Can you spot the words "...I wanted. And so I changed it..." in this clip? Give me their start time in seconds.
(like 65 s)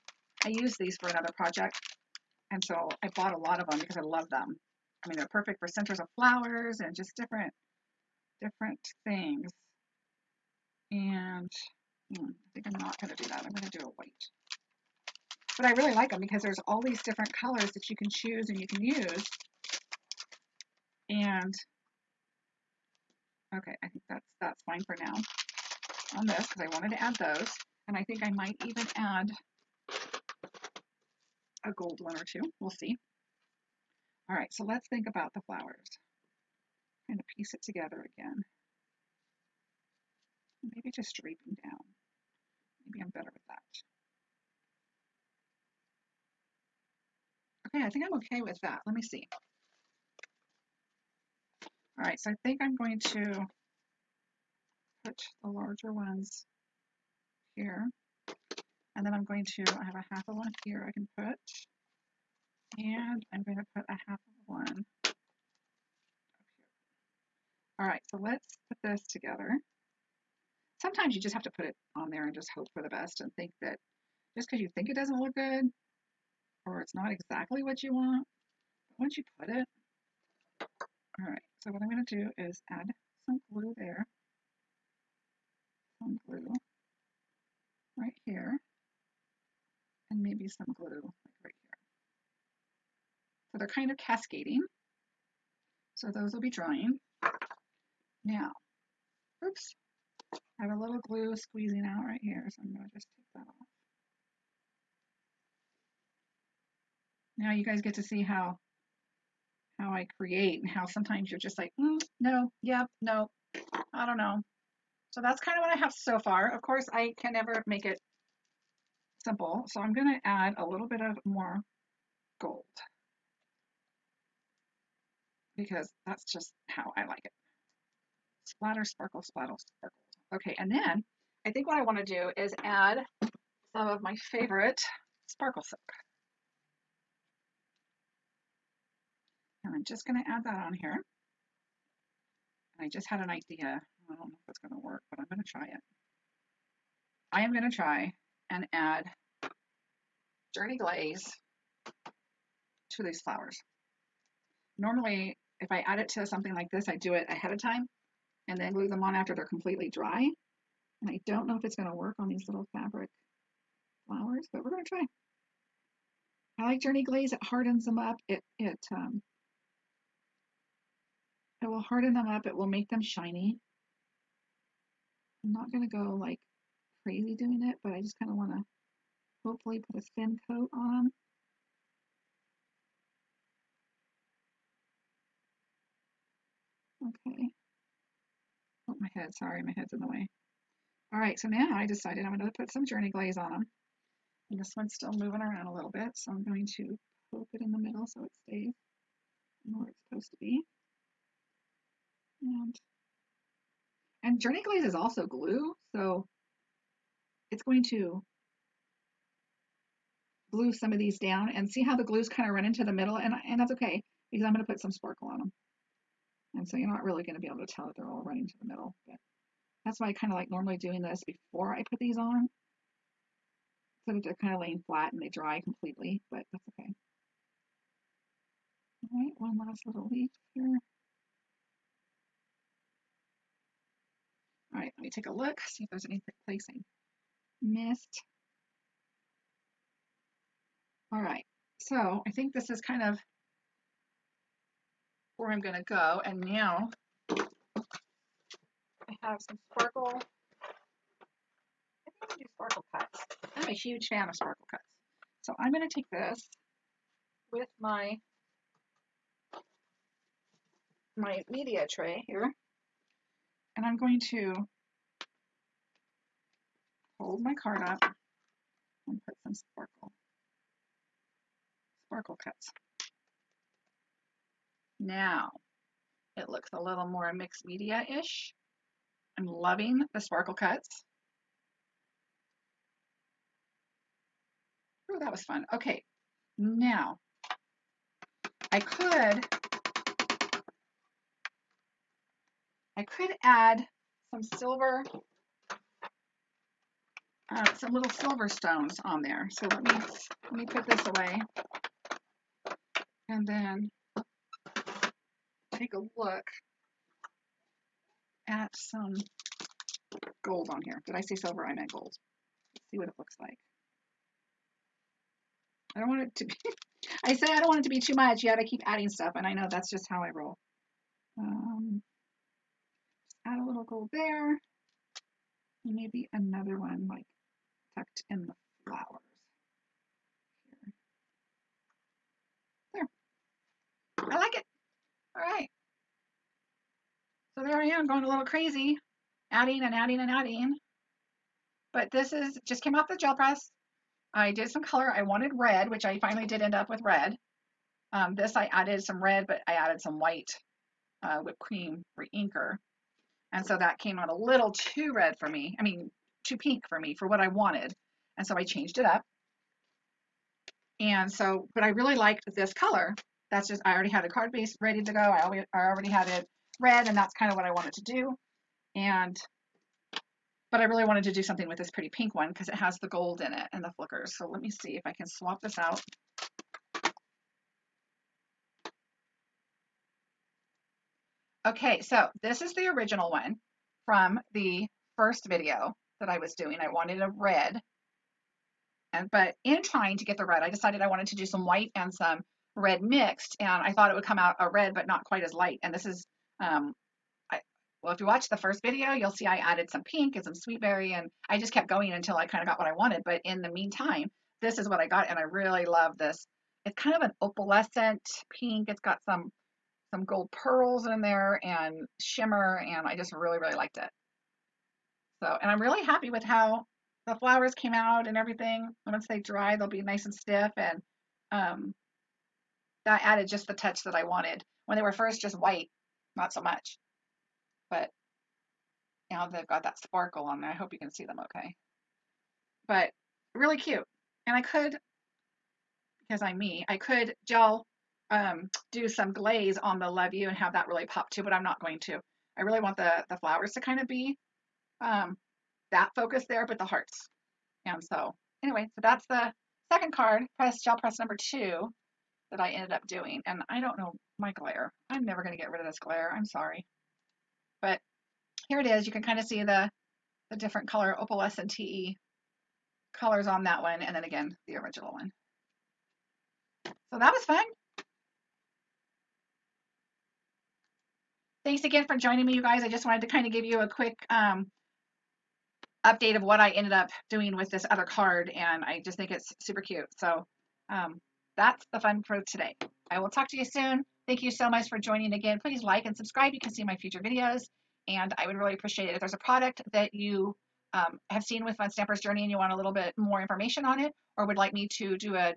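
357 s.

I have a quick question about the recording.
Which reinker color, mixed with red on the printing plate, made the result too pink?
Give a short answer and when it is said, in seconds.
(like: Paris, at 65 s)
Whipped cream, at 351 s.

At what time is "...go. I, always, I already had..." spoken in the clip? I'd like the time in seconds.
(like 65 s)
365 s.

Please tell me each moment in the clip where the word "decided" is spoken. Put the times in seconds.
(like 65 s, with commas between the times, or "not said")
191 s, 390 s.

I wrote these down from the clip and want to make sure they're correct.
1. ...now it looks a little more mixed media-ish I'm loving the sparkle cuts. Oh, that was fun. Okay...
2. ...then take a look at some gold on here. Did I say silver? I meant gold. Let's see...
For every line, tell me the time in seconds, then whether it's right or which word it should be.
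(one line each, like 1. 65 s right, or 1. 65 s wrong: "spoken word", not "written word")
1. 274 s right
2. 303 s right.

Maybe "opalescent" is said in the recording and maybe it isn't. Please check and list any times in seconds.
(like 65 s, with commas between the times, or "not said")
407 s, 461 s.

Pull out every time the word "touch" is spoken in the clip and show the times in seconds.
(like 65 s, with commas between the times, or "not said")
423 s.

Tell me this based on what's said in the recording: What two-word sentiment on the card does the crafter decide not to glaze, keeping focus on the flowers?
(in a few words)
Love you.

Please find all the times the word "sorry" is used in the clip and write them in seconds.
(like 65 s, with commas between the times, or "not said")
189 s, 456 s.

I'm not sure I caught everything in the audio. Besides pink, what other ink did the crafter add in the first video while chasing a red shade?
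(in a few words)
Sweet berry.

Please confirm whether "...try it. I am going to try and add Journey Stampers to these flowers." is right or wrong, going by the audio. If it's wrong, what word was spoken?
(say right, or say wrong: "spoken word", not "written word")
wrong: "Glaze", not "Stampers".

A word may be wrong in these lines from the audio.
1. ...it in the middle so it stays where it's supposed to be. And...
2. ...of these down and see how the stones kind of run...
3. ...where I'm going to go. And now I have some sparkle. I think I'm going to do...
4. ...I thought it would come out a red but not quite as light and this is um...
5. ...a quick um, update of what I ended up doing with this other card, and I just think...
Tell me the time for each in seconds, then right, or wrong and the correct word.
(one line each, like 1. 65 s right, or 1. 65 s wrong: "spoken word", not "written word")
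1. 197 s right
2. 210 s wrong: "glues", not "stones"
3. 245 s right
4. 393 s right
5. 473 s right.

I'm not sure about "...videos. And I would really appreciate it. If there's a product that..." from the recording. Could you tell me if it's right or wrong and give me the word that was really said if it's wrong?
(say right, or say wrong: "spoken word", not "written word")
right.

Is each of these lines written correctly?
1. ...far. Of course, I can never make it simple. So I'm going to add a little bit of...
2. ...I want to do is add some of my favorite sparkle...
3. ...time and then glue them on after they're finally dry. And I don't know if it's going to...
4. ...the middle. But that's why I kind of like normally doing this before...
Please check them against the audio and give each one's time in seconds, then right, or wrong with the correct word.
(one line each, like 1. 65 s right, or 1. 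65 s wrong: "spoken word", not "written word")
1. 116 s right
2. 131 s right
3. 157 s wrong: "completely", not "finally"
4. 218 s right.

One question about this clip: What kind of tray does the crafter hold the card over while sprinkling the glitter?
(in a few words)
Media tray.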